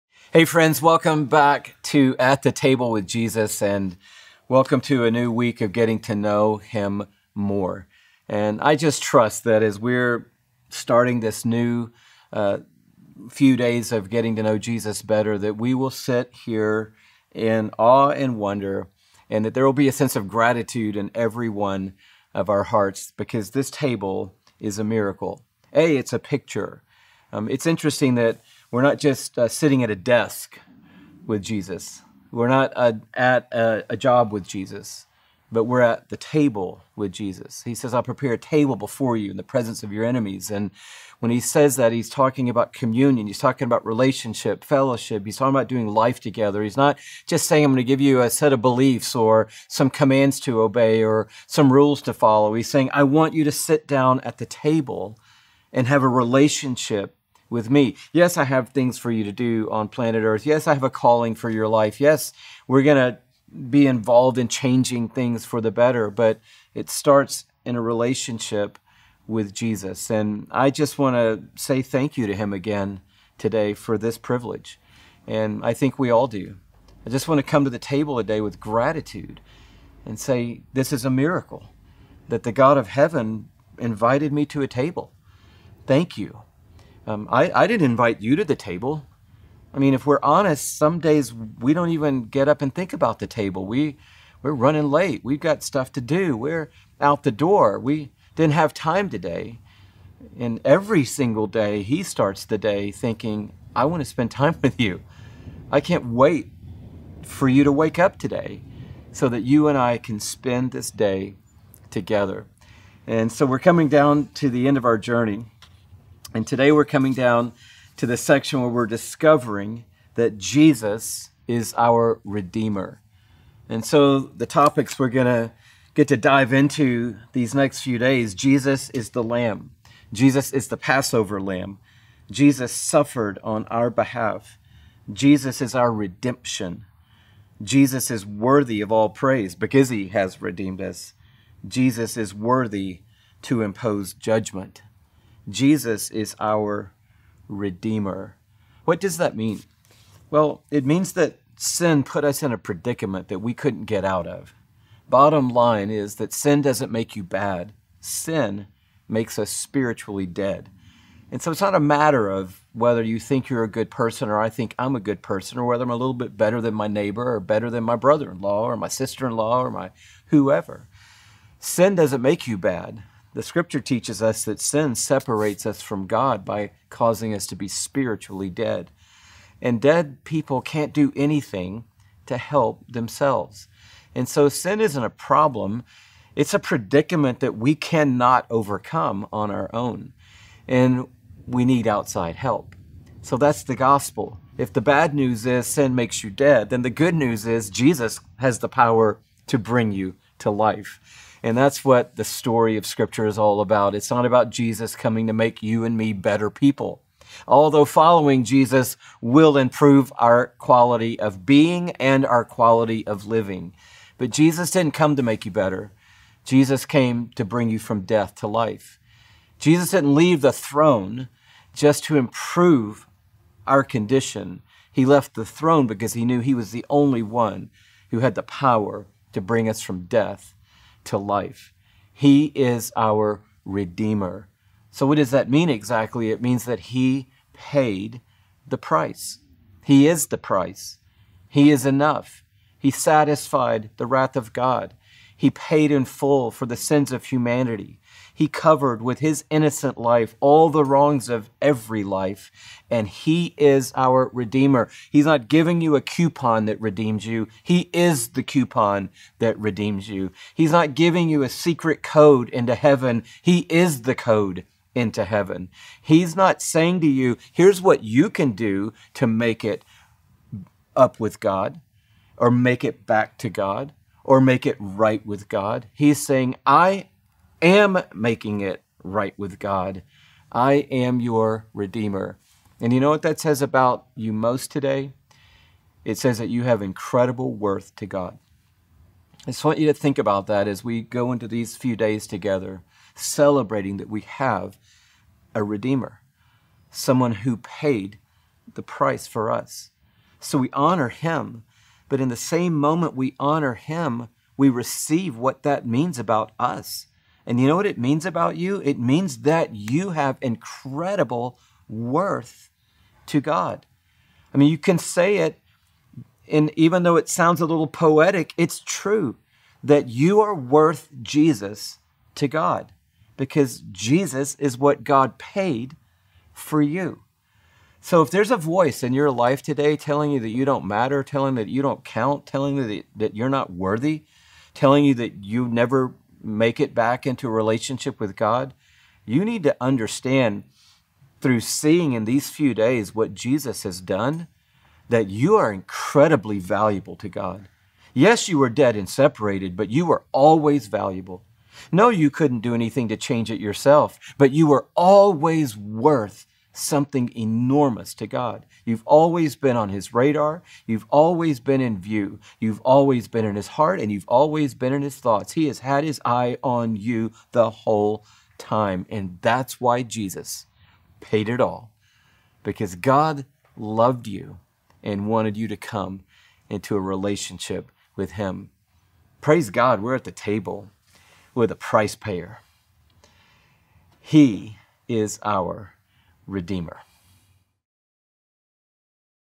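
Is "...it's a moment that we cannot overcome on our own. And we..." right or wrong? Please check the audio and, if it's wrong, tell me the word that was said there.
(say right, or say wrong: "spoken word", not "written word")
wrong: "predicament", not "moment".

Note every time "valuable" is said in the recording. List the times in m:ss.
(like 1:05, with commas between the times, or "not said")
5:46, 5:50.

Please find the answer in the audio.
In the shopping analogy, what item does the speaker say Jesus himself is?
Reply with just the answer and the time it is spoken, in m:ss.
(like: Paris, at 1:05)
the coupon, at 4:18.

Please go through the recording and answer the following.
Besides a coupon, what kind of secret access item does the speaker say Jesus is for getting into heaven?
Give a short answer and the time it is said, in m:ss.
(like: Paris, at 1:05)
the code, at 4:24.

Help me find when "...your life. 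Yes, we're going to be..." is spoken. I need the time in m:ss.
1:01.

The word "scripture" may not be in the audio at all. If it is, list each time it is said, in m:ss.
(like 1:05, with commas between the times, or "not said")
2:53, 3:22.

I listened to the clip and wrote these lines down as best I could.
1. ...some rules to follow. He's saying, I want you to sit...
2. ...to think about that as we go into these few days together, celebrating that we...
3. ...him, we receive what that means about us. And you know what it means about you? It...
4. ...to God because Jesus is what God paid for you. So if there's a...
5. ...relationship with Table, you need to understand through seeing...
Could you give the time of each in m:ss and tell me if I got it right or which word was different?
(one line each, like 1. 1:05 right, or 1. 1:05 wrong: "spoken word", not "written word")
1. 0:51 right
2. 4:49 right
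3. 5:03 right
4. 5:22 right
5. 5:37 wrong: "God", not "Table".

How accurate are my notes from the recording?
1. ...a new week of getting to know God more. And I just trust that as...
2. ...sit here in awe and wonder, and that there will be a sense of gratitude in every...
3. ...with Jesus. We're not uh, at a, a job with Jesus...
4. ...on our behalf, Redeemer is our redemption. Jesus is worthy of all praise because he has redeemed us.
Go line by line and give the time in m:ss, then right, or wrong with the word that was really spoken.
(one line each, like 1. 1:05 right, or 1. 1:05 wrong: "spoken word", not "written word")
1. 0:05 wrong: "Him", not "God"
2. 0:15 right
3. 0:31 right
4. 2:13 wrong: "Jesus", not "Redeemer".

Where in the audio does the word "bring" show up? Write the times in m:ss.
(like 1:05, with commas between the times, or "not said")
3:19, 3:37, 3:49.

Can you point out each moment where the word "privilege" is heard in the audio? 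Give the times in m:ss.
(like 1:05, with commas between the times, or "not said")
1:14.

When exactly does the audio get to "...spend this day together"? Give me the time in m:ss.
1:50.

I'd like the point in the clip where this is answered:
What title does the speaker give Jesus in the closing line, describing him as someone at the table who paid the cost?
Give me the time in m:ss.
6:21.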